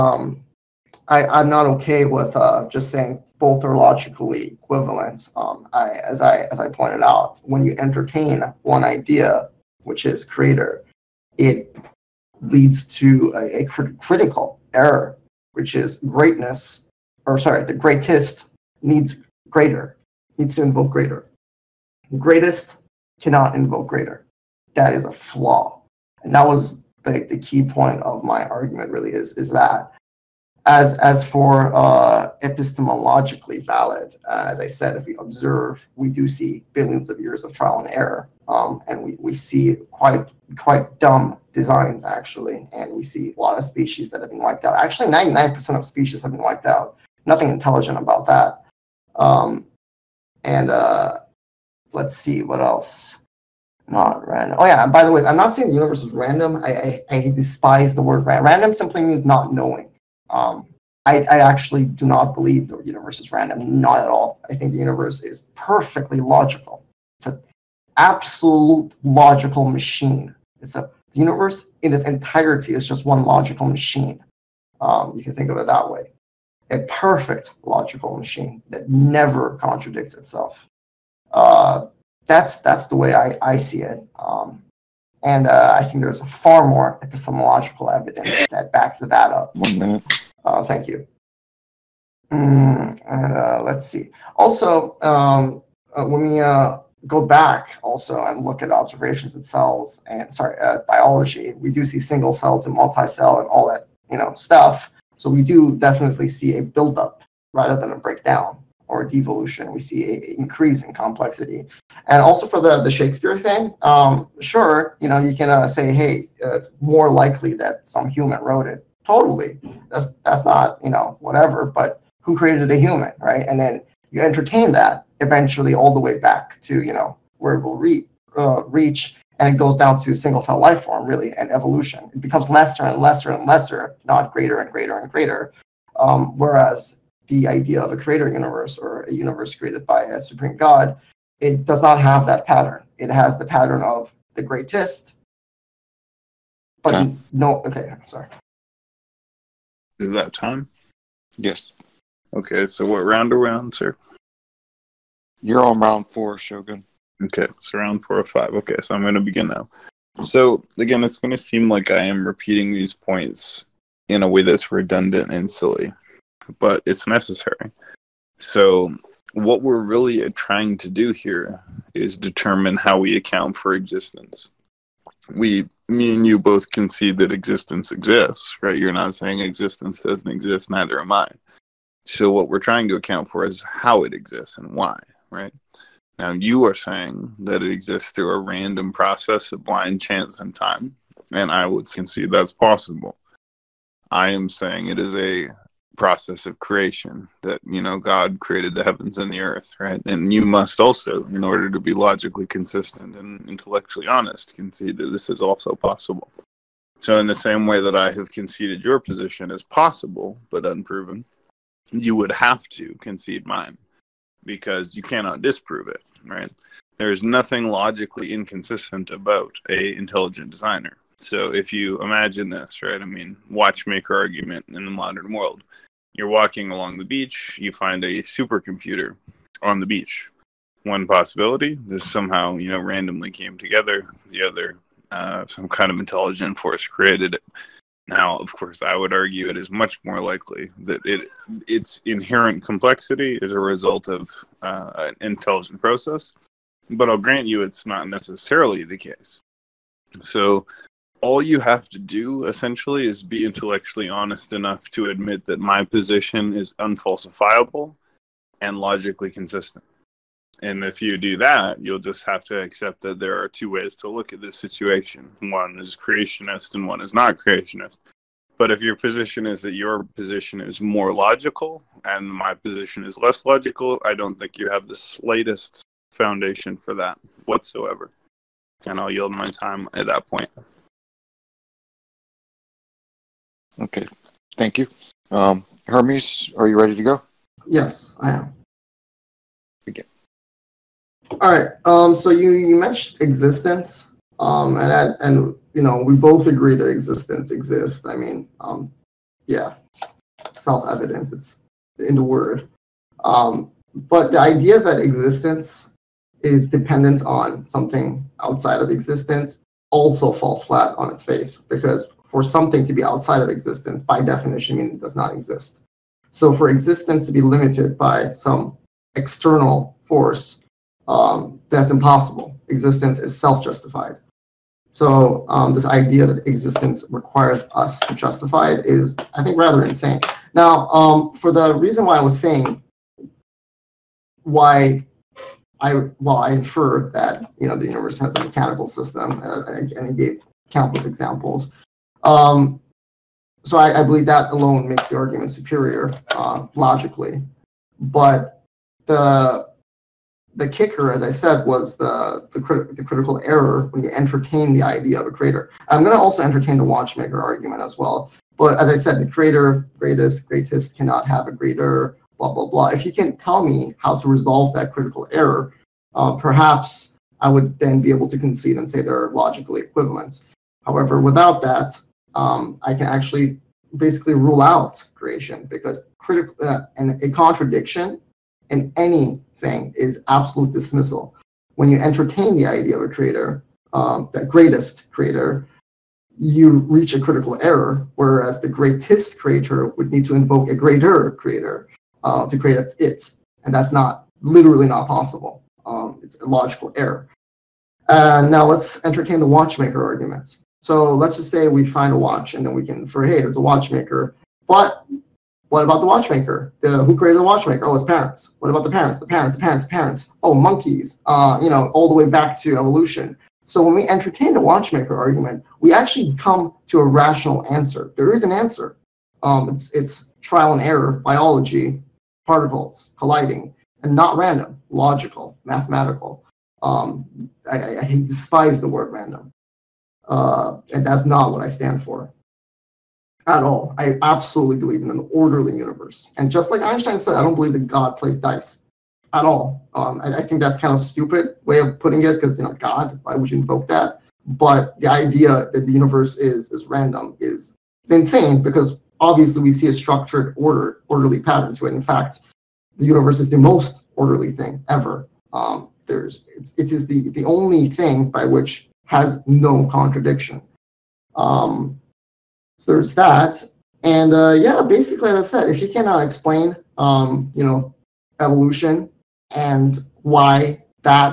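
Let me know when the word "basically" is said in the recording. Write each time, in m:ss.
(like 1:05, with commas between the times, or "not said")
6:13, 7:44.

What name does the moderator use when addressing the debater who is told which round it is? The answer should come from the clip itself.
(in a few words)
Shogun.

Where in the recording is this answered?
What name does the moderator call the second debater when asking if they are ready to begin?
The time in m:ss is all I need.
4:45.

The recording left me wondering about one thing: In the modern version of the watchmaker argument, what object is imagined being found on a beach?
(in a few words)
A supercomputer.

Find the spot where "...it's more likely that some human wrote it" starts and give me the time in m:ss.
1:56.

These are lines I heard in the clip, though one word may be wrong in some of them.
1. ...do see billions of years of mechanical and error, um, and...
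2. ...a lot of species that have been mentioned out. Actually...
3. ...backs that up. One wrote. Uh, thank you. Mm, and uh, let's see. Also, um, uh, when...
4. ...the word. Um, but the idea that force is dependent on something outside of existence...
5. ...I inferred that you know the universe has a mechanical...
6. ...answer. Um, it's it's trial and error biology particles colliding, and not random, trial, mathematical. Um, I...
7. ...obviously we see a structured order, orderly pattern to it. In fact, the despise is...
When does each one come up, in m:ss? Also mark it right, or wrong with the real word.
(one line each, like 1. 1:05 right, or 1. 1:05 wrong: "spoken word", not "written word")
1. 0:36 wrong: "trial", not "mechanical"
2. 0:43 wrong: "wiped", not "mentioned"
3. 1:28 wrong: "minute", not "wrote"
4. 5:02 wrong: "existence", not "force"
5. 5:36 right
6. 6:58 wrong: "logical", not "trial"
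7. 7:29 wrong: "universe", not "despise".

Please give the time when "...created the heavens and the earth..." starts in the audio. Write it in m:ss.
3:18.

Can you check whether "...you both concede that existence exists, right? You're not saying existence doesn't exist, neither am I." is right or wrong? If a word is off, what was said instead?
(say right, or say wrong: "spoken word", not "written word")
right.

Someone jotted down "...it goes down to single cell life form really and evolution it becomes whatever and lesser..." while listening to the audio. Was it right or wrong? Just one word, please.
wrong.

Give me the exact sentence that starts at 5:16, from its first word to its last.
So for existence to be limited by some external force, um, that's impossible.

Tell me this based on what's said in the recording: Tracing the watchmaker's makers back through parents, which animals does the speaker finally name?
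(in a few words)
Monkeys.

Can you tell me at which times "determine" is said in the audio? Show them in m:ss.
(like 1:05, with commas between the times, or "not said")
2:52.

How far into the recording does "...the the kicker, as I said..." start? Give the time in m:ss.
5:49.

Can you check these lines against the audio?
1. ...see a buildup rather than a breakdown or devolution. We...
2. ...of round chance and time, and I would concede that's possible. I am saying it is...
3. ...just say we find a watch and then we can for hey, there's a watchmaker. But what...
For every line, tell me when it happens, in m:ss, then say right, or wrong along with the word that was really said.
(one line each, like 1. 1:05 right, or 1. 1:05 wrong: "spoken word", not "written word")
1. 1:46 right
2. 3:09 wrong: "blind", not "round"
3. 6:41 right.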